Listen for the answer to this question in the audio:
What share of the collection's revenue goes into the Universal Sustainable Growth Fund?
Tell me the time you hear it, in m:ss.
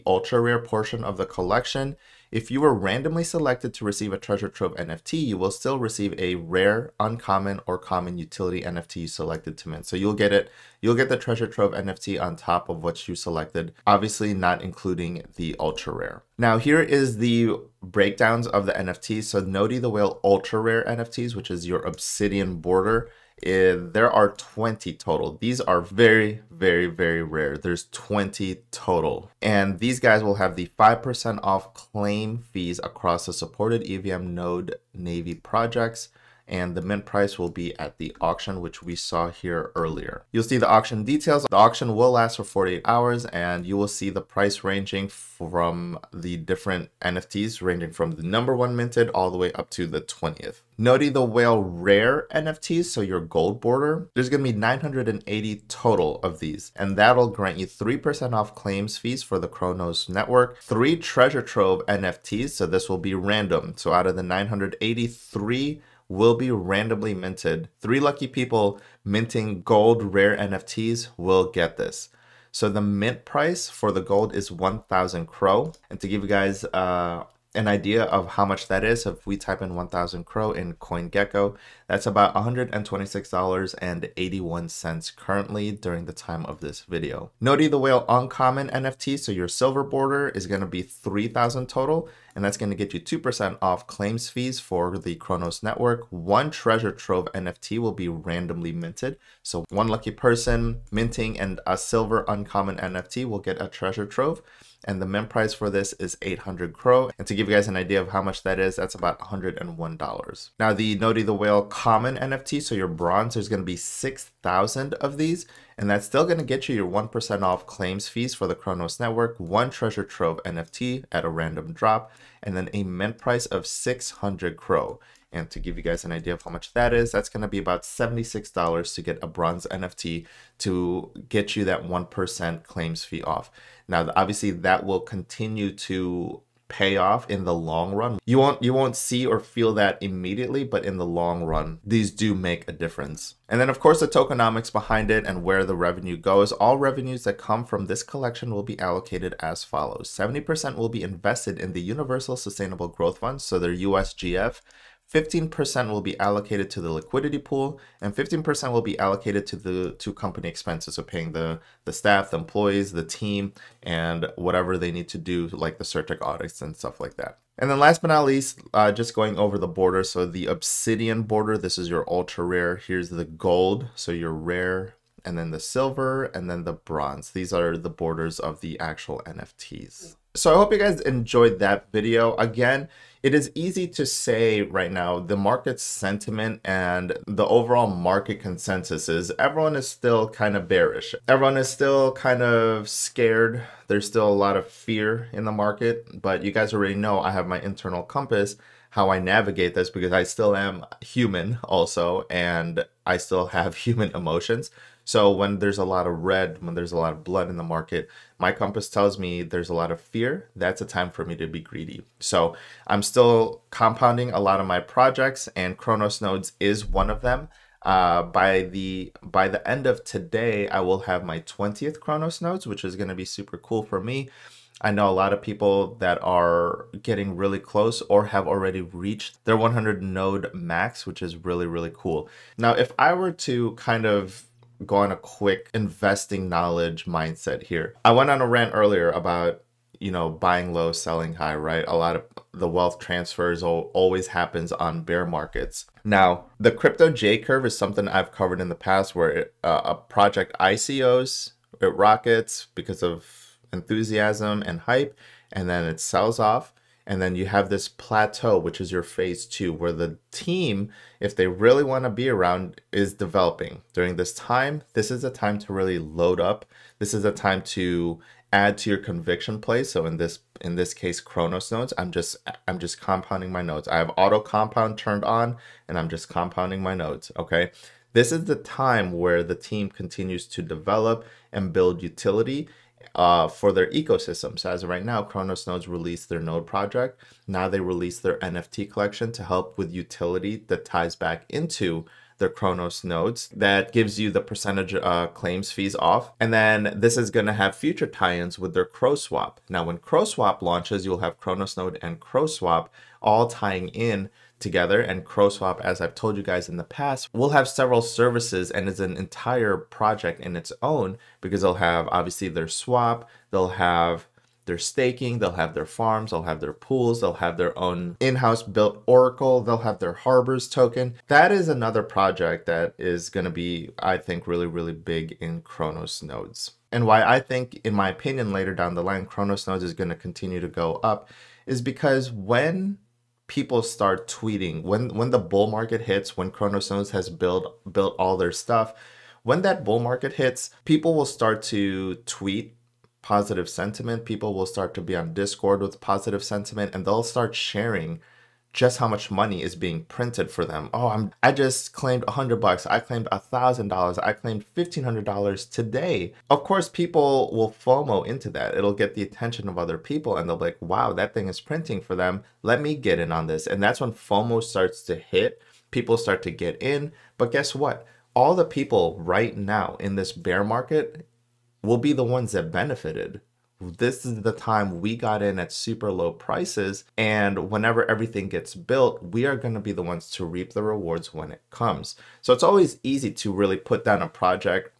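2:30.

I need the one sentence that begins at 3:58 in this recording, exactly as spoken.
I went on a rant earlier about, you know, buying low, selling high, right?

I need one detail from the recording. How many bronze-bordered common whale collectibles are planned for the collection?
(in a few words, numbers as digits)
6,000.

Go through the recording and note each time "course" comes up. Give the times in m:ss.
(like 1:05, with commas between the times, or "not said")
2:23, 5:56.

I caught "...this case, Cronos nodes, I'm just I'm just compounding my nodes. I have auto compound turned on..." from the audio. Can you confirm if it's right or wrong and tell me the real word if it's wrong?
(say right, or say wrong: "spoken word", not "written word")
right.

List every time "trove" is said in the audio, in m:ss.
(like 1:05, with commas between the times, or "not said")
0:04, 0:11, 1:01, 1:36, 1:44, 2:00.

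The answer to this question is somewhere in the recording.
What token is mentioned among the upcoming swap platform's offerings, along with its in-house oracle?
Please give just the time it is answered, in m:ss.
5:20.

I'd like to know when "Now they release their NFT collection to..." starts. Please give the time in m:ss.
4:47.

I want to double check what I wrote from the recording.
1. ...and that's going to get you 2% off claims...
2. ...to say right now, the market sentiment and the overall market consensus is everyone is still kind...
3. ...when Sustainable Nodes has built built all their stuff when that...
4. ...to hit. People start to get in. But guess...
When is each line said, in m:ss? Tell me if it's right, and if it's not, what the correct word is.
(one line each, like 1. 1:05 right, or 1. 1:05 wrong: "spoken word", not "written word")
1. 1:32 right
2. 3:03 right
3. 5:36 wrong: "Cronos", not "Sustainable"
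4. 6:05 right.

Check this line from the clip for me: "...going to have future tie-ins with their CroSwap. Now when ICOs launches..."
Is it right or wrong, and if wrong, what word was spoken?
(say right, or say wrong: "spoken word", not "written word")
wrong: "CroSwap", not "ICOs".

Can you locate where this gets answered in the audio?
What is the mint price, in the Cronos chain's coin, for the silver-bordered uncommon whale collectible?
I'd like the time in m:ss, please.
1:46.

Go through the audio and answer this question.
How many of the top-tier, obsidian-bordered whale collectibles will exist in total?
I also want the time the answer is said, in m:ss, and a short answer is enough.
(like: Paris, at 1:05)
20, at 0:23.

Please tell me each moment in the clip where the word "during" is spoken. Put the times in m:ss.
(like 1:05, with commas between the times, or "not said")
1:25, 4:23.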